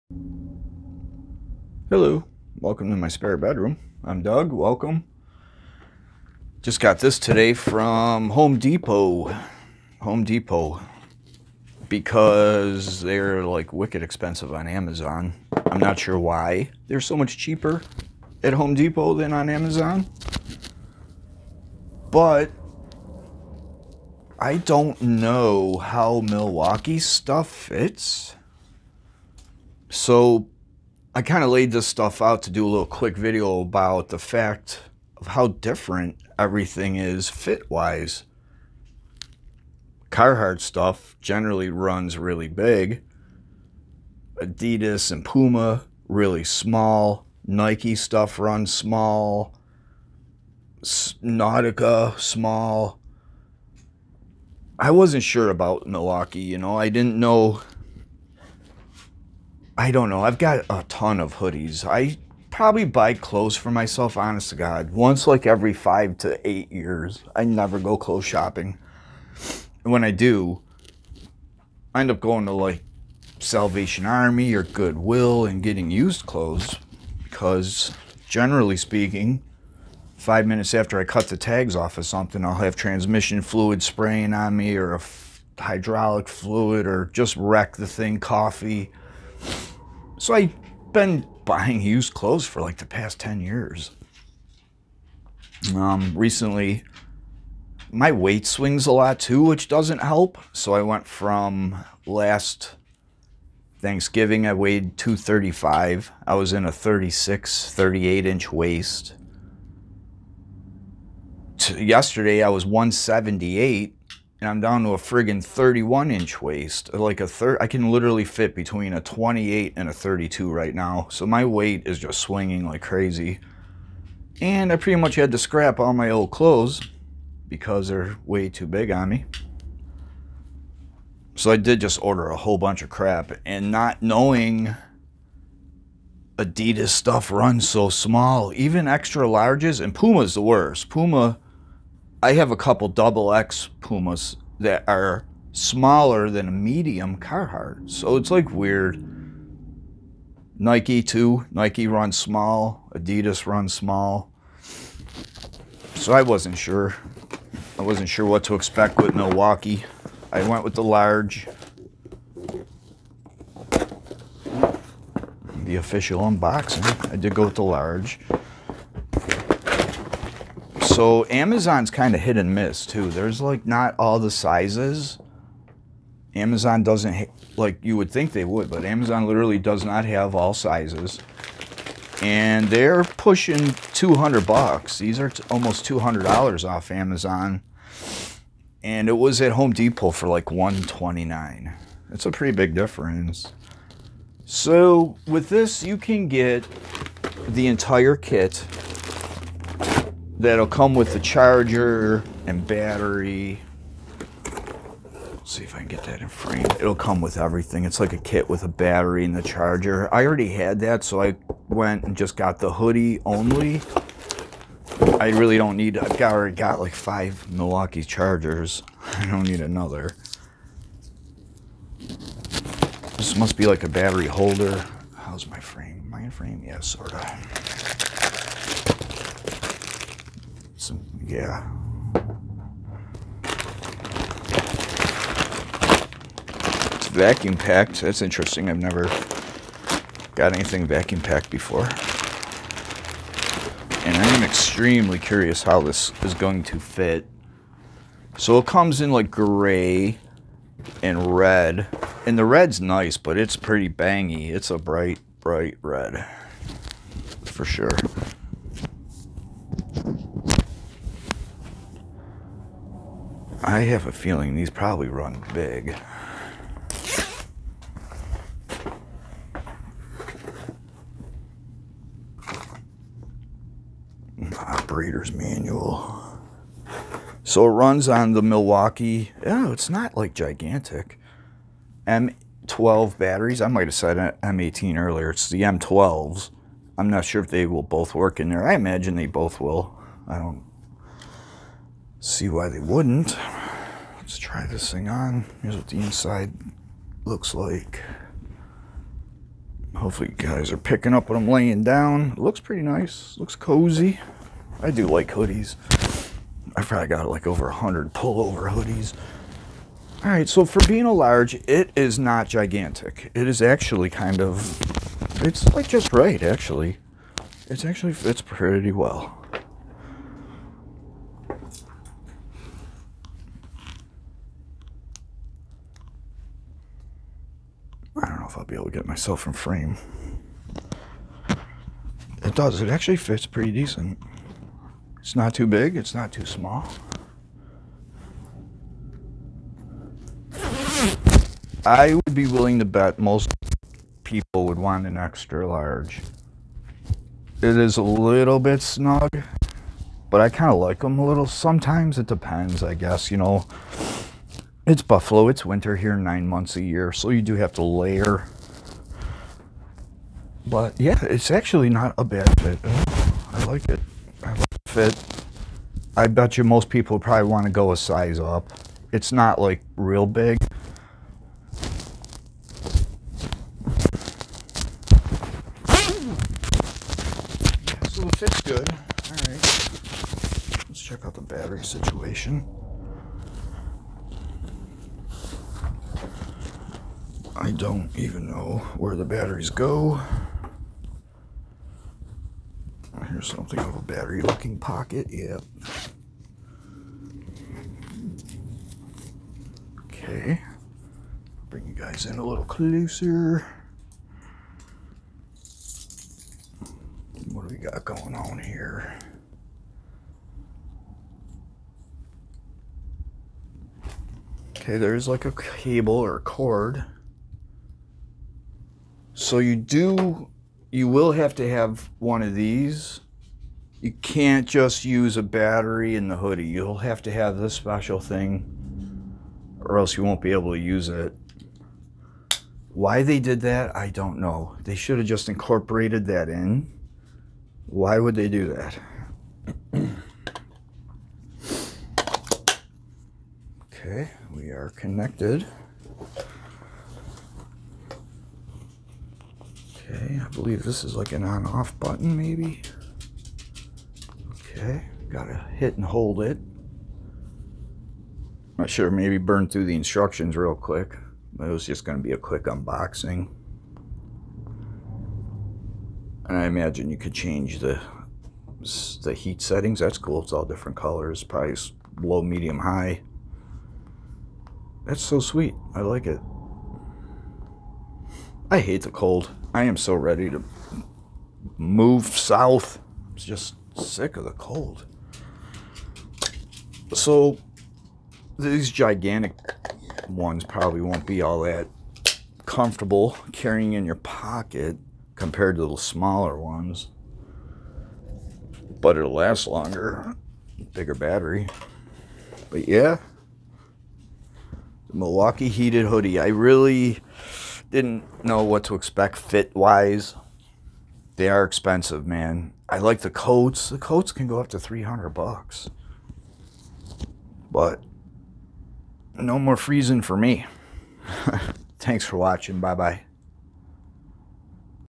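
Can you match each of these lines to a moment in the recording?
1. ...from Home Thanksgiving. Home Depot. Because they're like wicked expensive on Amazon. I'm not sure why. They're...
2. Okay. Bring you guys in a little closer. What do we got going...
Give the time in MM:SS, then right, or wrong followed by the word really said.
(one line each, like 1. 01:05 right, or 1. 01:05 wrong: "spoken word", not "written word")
1. 00:07 wrong: "Depot", not "Thanksgiving"
2. 06:40 right.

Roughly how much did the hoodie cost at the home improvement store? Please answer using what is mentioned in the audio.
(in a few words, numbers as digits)
$129.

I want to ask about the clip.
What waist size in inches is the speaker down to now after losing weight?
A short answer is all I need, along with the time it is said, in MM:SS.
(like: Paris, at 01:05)
31, at 01:55.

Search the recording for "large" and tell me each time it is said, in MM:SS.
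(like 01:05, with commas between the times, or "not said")
02:19, 02:40, 02:47, 05:11, 05:45.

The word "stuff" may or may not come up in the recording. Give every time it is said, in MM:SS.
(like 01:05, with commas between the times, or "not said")
00:26, 00:31, 00:40, 00:47, 02:16.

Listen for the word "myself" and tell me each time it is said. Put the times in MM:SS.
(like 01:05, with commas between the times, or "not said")
01:03, 05:29.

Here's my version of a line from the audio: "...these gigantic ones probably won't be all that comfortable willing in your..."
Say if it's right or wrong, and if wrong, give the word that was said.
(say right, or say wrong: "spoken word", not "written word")
wrong: "carrying", not "willing".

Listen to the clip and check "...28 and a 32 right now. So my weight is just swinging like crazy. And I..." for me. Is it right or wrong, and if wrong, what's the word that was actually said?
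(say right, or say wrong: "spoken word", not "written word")
right.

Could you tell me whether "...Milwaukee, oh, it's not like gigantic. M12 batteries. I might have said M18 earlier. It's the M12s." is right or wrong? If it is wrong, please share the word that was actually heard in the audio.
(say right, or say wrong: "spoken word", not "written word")
right.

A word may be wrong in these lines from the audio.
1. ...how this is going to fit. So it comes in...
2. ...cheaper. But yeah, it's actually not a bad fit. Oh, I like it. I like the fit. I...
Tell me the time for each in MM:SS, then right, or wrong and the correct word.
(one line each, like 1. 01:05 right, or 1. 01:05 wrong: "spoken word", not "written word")
1. 04:05 right
2. 05:57 wrong: "layer", not "cheaper".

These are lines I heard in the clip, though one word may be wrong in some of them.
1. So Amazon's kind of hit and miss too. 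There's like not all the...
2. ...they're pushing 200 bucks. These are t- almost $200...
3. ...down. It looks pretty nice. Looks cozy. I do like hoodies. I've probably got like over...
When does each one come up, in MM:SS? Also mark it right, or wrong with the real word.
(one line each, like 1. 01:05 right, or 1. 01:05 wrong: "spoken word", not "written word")
1. 02:50 right
2. 03:02 right
3. 05:01 right.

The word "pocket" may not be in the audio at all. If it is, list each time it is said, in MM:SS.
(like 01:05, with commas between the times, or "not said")
06:34, 08:14.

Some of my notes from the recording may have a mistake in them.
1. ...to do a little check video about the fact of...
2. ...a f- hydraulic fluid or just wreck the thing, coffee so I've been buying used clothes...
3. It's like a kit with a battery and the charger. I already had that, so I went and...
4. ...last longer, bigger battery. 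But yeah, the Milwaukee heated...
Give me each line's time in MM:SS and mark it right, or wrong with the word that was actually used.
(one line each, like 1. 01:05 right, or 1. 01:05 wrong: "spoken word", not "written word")
1. 00:32 wrong: "quick", not "check"
2. 01:24 right
3. 03:27 right
4. 08:19 right.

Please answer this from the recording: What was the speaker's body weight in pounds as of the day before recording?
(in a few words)
178.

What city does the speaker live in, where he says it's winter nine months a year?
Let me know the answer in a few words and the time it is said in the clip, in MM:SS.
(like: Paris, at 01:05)
Buffalo, at 05:53.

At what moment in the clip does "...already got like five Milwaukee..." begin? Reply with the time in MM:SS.
03:36.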